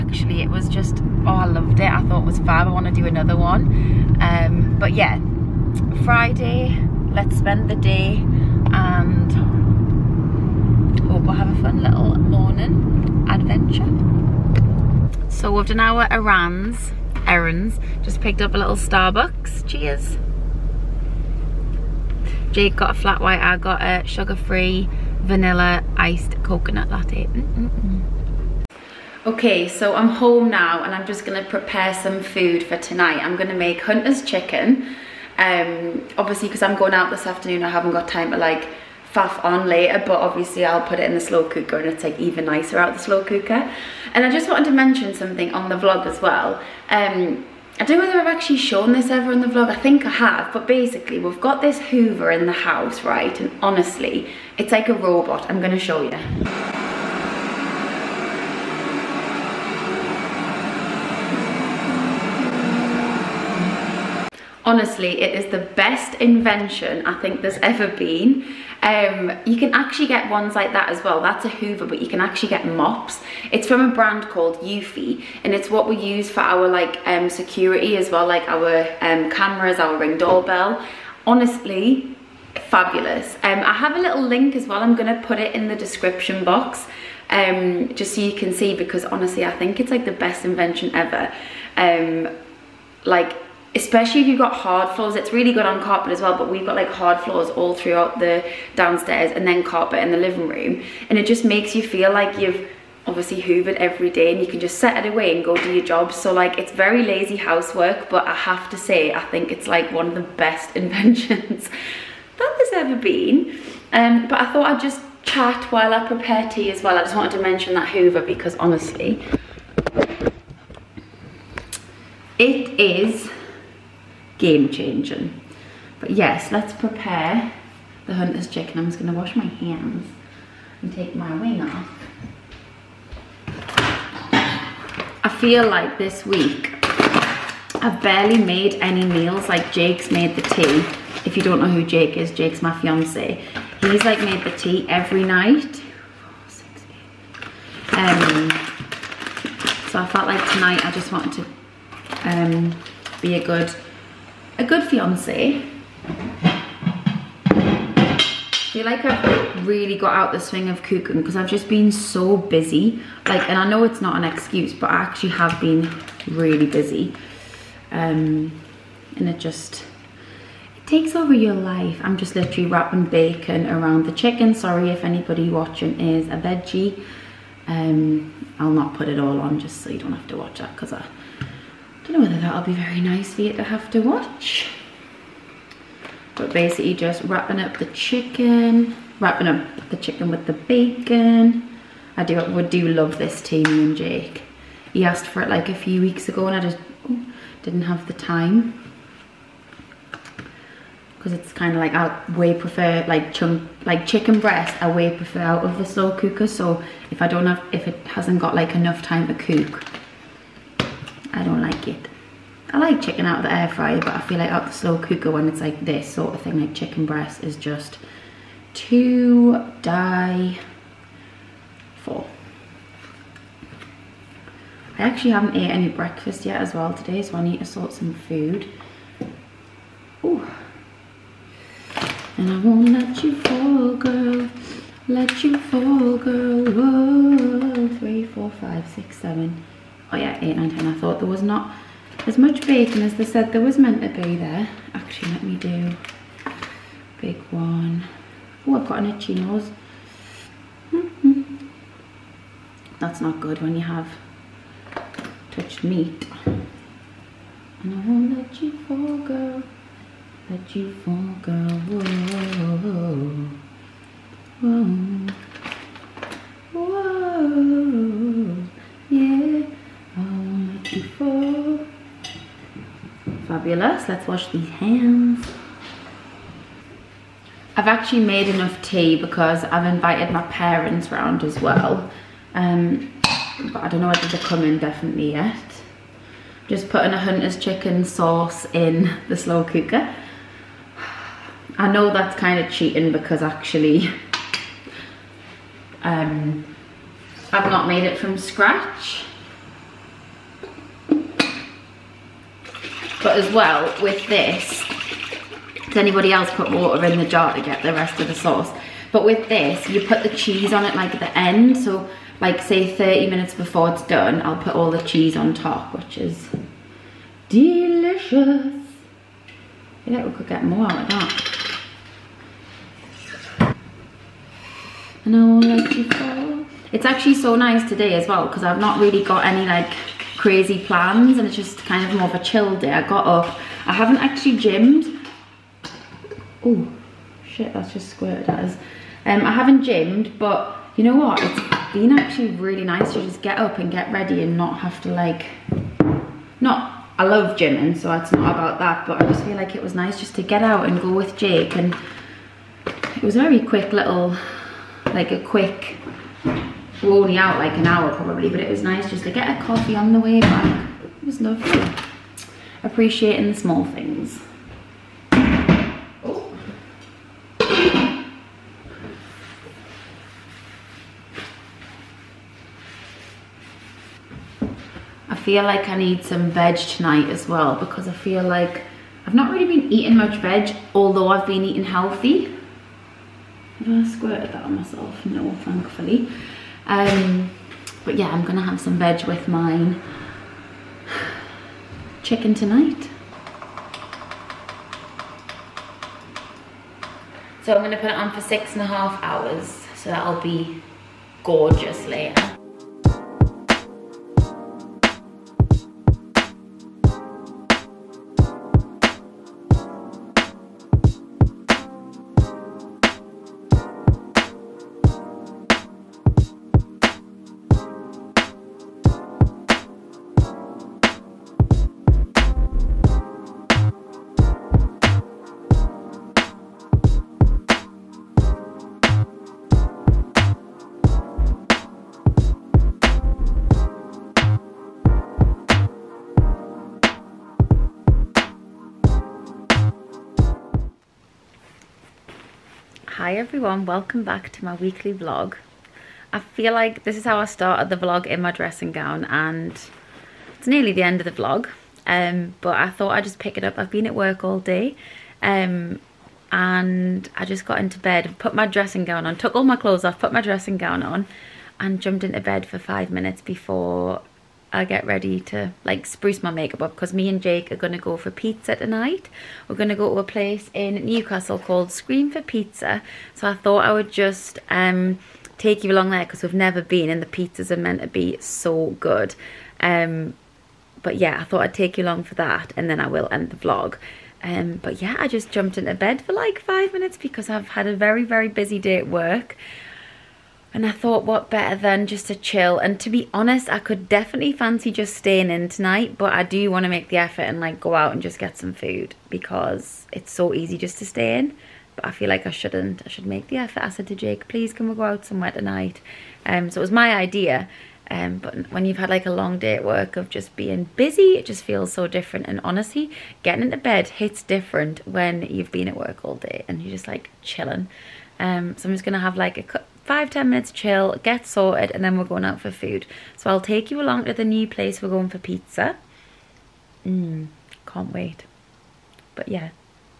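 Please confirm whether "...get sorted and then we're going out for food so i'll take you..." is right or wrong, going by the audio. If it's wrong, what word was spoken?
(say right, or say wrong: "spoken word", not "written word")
right.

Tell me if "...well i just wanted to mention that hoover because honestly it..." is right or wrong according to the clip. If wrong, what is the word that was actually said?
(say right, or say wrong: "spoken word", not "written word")
right.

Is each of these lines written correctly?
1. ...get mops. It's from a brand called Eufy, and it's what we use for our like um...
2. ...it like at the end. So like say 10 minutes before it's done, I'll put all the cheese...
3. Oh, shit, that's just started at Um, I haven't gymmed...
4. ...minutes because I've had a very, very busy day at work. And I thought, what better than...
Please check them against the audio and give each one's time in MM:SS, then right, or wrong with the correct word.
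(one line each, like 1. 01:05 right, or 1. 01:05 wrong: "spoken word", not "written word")
1. 01:12 right
2. 05:10 wrong: "30", not "10"
3. 05:36 wrong: "squirted", not "started"
4. 08:06 right.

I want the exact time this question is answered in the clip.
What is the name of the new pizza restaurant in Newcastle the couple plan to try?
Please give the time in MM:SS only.
07:51.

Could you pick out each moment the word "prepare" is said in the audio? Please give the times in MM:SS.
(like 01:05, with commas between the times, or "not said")
00:31, 01:56, 02:06.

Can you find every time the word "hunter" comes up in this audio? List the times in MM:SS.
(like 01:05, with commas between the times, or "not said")
00:33, 02:08, 04:47.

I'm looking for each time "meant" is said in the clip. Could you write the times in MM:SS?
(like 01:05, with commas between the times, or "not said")
04:03, 07:57.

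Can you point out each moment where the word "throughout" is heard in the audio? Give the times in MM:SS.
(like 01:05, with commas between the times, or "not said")
01:37.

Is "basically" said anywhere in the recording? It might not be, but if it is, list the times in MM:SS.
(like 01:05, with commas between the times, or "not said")
00:50, 03:06.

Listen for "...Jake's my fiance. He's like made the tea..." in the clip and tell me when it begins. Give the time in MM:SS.
02:22.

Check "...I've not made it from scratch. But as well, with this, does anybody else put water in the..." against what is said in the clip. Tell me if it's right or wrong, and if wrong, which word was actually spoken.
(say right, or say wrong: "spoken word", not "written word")
right.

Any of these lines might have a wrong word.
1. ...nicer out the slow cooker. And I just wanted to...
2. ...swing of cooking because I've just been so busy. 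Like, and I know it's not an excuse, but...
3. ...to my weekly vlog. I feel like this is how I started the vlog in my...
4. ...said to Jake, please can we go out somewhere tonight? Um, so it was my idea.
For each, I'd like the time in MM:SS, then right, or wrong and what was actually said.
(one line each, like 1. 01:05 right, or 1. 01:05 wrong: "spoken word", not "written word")
1. 00:42 right
2. 02:40 right
3. 07:24 right
4. 08:23 right.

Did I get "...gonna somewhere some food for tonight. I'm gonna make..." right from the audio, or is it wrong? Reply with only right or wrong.
wrong.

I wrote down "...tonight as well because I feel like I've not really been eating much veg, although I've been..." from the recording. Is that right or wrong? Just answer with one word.
right.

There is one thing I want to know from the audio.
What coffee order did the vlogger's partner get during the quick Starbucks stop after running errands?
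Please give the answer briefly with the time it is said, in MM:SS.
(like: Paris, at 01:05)
Flat white, at 00:22.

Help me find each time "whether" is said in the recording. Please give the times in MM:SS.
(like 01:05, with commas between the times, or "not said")
00:48, 03:02, 04:44.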